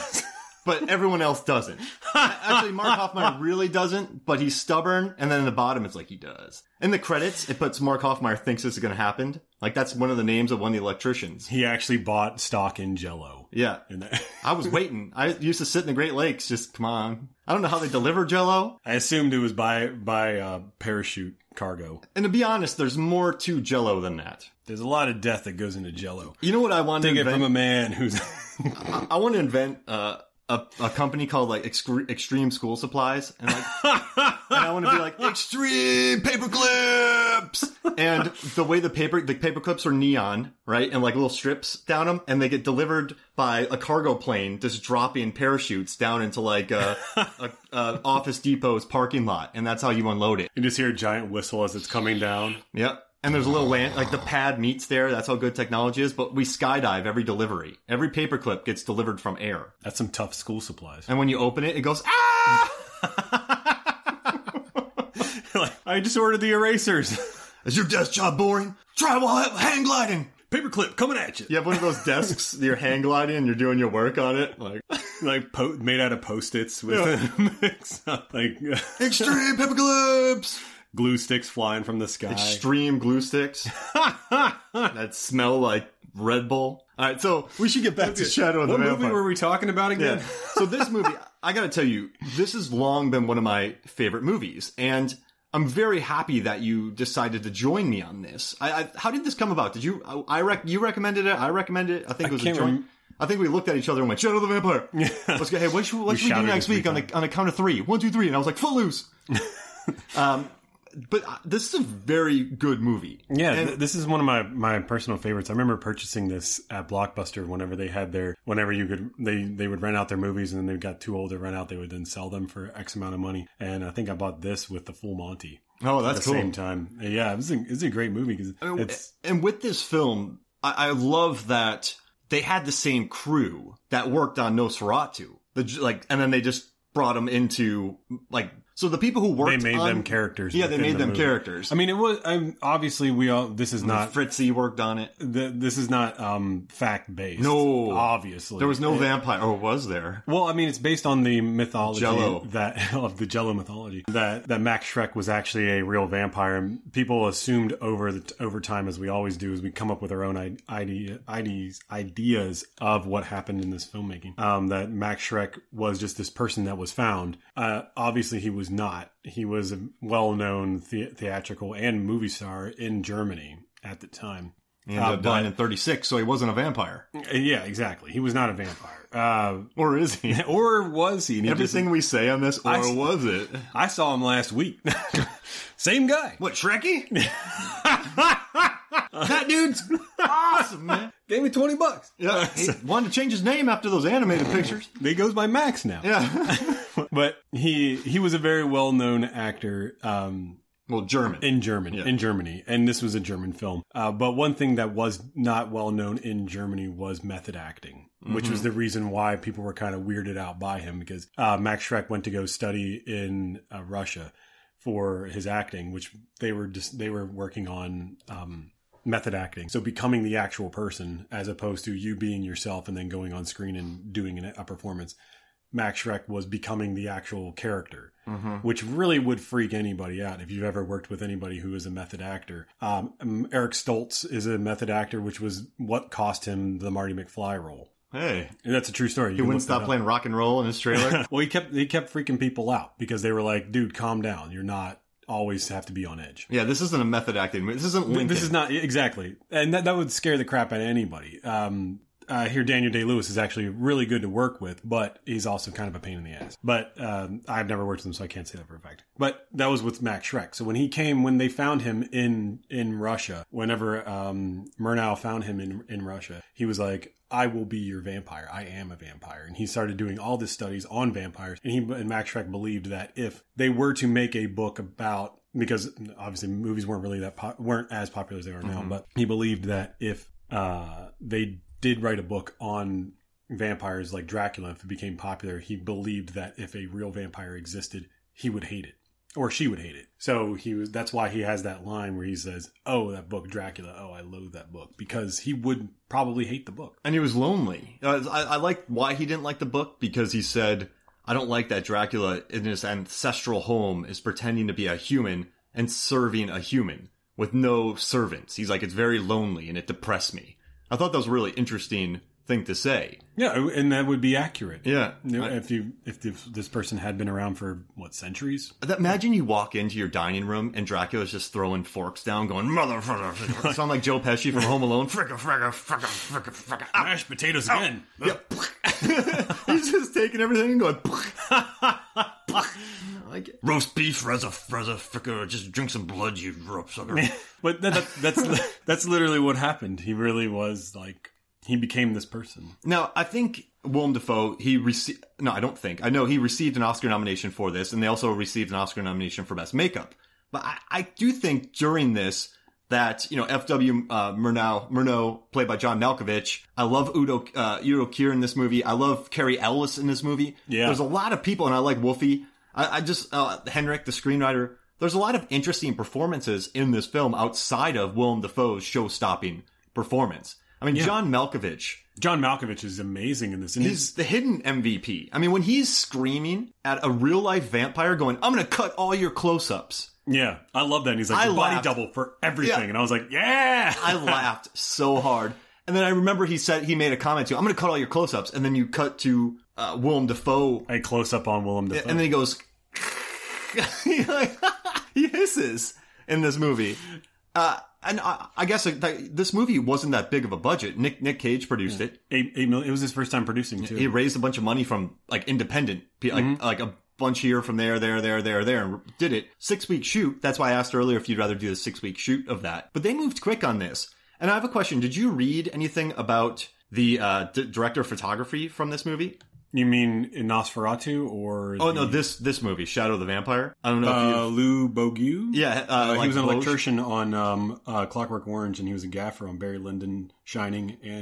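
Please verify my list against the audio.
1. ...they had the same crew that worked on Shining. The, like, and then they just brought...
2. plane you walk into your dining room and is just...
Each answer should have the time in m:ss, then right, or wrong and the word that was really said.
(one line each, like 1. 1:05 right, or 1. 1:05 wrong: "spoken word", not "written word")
1. 2:12 wrong: "Nosferatu", not "Shining"
2. 5:18 wrong: "imagine", not "plane".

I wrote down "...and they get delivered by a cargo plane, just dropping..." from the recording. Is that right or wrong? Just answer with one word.
right.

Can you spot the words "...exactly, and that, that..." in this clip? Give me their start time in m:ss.
4:08.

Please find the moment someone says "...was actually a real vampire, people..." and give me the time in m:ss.
2:35.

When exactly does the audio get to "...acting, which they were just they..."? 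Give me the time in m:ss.
3:35.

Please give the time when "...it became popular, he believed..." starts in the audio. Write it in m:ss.
4:44.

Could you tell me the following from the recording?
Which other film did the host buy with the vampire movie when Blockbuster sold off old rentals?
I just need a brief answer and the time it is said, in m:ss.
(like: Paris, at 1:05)
The Full Monty, at 2:04.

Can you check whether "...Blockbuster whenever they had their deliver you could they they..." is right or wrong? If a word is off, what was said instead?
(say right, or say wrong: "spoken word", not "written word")
wrong: "whenever", not "deliver".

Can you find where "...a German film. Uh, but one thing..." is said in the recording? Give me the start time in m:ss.
3:23.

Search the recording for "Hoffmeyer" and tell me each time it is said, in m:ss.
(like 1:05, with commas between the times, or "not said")
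0:02, 0:08.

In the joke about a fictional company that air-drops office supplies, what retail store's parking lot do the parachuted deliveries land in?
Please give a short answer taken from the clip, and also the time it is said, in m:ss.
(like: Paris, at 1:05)
Office Depot, at 0:48.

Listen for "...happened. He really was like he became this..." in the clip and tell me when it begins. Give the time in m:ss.
5:39.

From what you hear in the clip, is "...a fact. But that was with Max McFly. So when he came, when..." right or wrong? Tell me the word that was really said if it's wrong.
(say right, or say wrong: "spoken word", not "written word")
wrong: "Schreck", not "McFly".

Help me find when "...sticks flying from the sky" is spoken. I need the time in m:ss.
1:21.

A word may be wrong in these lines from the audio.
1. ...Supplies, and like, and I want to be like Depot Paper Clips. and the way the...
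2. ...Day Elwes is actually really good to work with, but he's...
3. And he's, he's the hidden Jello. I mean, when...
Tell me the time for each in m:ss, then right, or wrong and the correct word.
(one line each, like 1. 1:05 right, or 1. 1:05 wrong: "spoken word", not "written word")
1. 0:32 wrong: "Extreme", not "Depot"
2. 4:12 wrong: "Lewis", not "Elwes"
3. 6:13 wrong: "MVP", not "Jello".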